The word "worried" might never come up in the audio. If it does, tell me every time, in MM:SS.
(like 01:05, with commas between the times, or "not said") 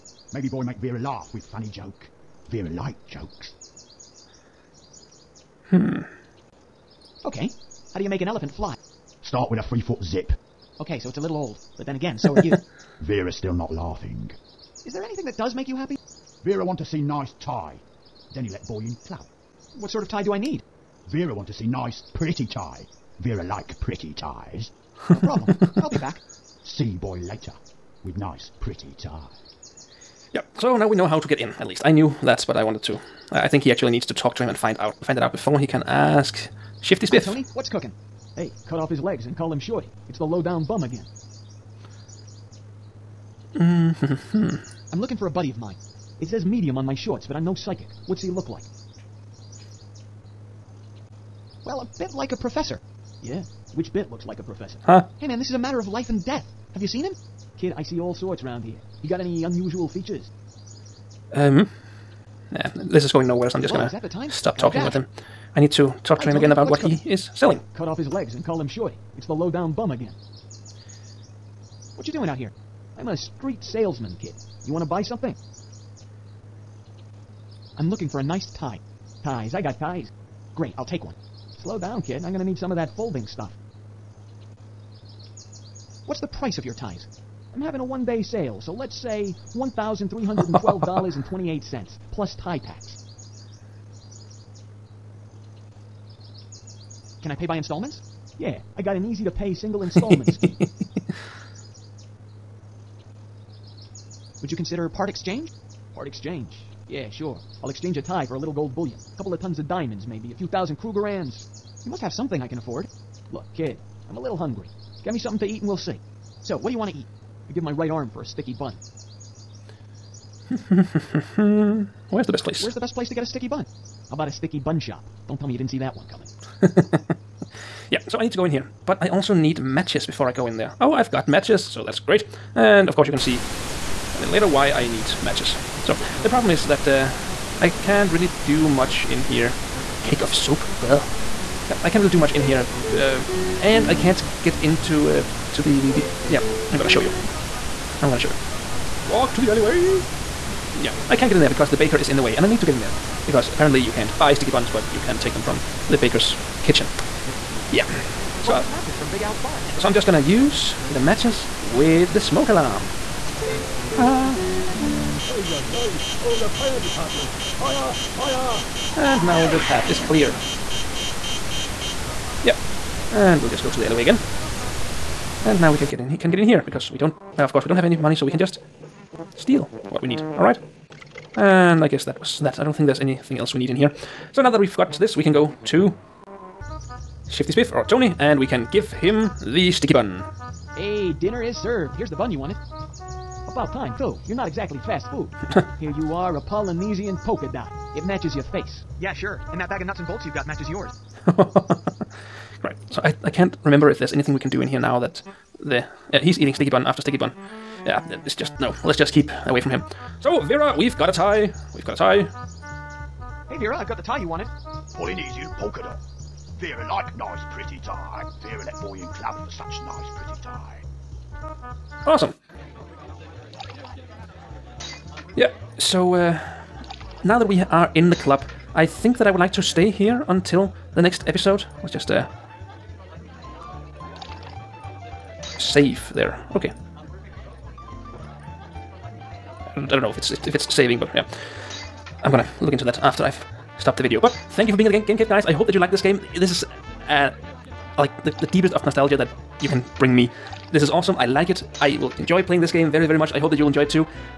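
not said.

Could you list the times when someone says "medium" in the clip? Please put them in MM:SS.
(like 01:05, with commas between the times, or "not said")
00:46.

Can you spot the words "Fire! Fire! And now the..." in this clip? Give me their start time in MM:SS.
02:47.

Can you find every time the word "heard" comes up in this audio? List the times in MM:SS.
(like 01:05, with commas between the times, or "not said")
not said.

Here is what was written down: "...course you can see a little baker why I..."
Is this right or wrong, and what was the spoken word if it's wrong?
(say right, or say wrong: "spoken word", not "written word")
wrong: "later", not "baker".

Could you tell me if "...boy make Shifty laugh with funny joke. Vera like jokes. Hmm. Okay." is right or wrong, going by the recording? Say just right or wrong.
wrong.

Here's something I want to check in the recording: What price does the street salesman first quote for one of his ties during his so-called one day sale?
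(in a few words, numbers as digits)
$1,312.28.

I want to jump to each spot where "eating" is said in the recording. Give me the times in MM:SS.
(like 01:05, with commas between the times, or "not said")
03:26.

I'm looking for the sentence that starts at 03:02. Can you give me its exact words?
I don't think there's anything else we need in here.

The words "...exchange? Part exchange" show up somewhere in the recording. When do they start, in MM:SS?
01:45.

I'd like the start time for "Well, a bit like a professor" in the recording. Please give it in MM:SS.
00:51.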